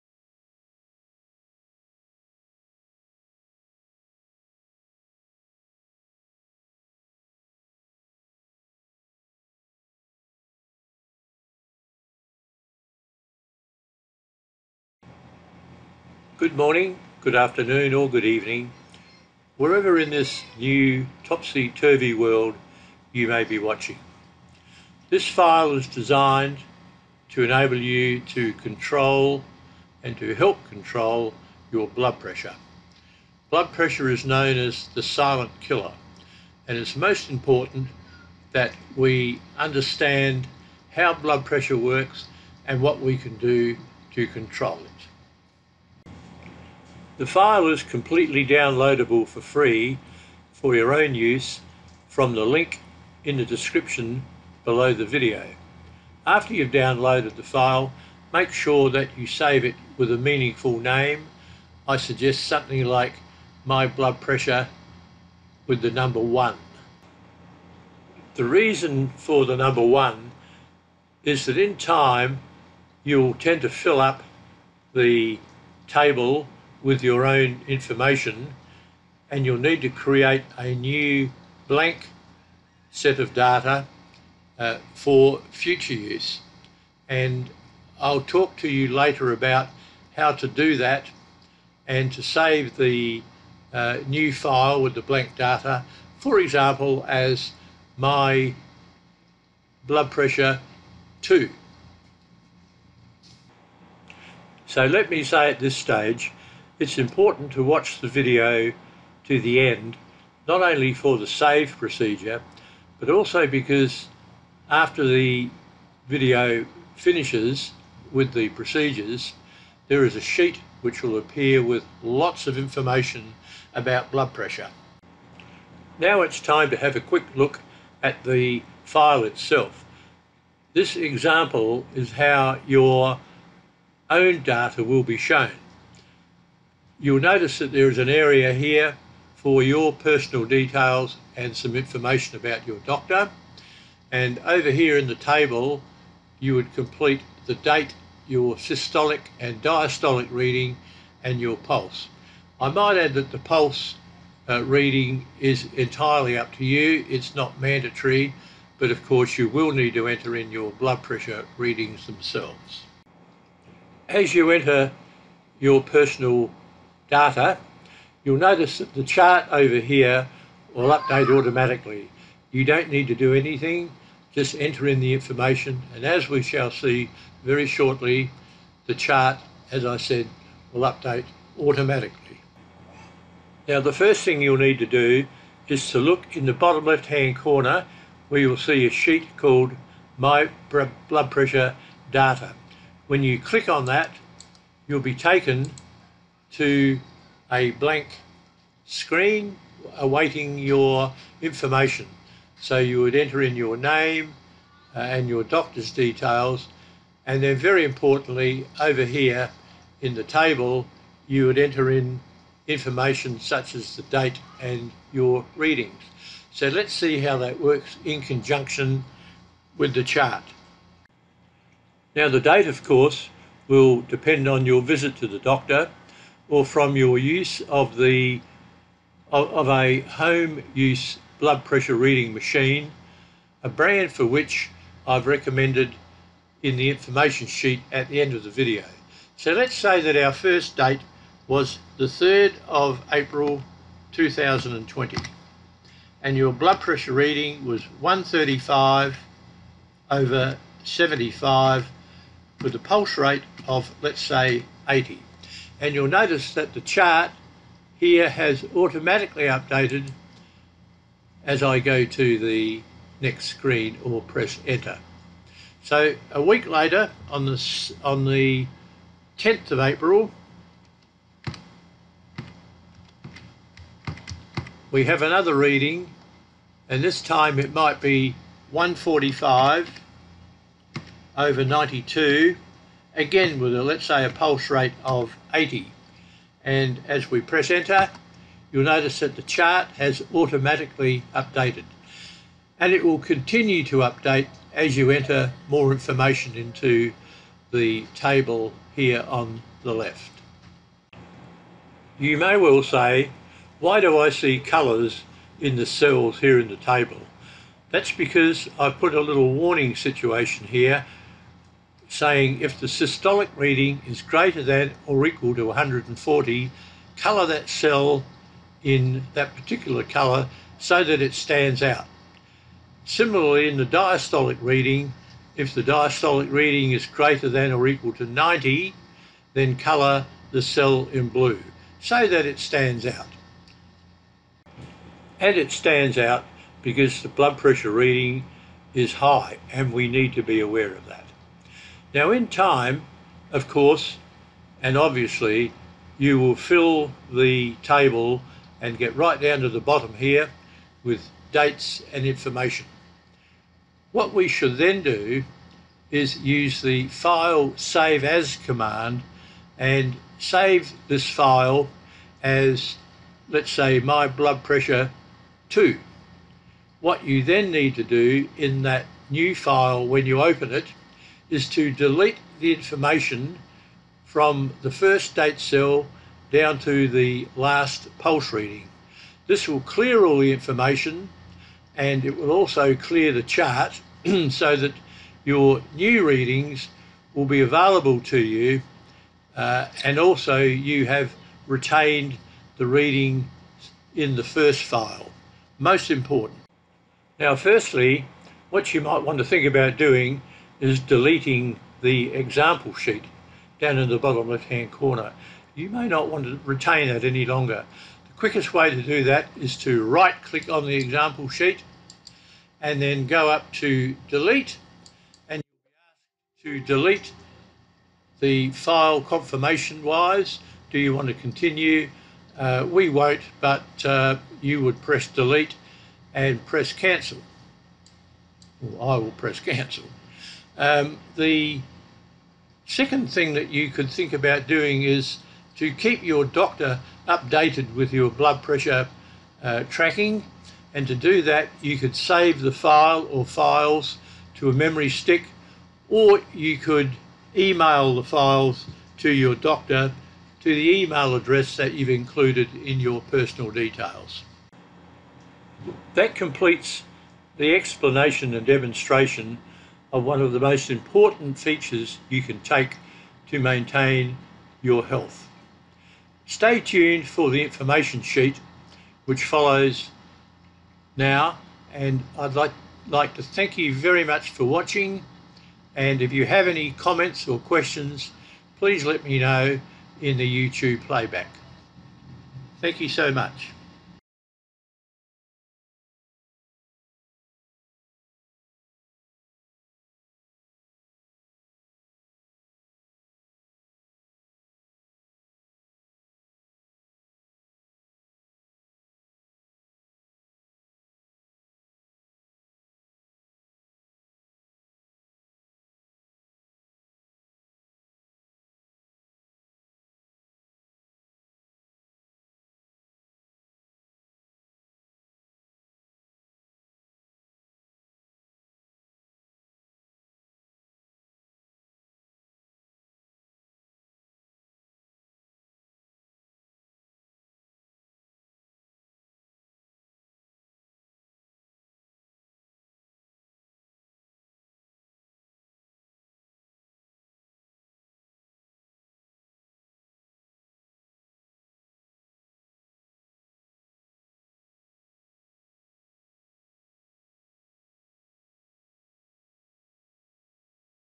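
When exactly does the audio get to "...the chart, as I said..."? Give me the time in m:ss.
2:58.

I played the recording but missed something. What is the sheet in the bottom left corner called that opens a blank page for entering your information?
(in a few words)
My Blood Pressure Data.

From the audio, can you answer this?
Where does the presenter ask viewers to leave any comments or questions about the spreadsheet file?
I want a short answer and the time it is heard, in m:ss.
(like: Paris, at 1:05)
YouTube playback, at 8:00.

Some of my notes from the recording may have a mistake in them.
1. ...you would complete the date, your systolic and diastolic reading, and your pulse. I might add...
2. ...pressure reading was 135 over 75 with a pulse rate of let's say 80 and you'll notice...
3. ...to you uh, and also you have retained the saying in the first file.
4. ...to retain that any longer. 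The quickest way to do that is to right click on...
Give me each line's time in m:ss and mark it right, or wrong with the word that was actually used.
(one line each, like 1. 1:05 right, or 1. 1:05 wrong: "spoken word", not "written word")
1. 2:26 right
2. 4:06 right
3. 6:28 wrong: "reading", not "saying"
4. 6:46 right.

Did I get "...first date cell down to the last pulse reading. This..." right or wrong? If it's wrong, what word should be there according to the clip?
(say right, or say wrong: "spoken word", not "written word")
right.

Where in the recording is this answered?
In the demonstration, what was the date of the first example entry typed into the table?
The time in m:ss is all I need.
4:02.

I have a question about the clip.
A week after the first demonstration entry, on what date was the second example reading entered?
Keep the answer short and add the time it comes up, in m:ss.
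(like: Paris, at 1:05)
10 April, at 4:29.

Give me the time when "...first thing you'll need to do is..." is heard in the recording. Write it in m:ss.
3:03.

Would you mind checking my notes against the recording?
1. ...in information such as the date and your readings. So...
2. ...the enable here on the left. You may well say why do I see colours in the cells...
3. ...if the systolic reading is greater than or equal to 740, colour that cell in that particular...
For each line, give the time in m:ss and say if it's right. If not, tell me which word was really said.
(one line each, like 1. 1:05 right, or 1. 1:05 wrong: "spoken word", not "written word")
1. 3:31 right
2. 4:57 wrong: "table", not "enable"
3. 5:12 wrong: "140", not "740".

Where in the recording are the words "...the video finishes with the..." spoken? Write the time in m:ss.
1:55.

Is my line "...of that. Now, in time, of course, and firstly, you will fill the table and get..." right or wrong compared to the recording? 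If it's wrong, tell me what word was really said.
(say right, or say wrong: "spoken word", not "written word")
wrong: "obviously", not "firstly".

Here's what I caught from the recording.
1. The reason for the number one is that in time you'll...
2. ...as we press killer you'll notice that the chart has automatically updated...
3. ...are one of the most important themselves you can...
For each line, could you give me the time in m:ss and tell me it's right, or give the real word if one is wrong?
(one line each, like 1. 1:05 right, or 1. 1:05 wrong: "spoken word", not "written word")
1. 1:08 right
2. 4:47 wrong: "enter", not "killer"
3. 7:40 wrong: "features", not "themselves".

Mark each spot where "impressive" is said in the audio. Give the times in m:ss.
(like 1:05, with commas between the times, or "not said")
not said.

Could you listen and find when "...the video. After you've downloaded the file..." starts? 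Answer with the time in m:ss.
0:54.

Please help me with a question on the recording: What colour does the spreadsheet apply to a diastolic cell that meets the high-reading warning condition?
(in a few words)
Blue.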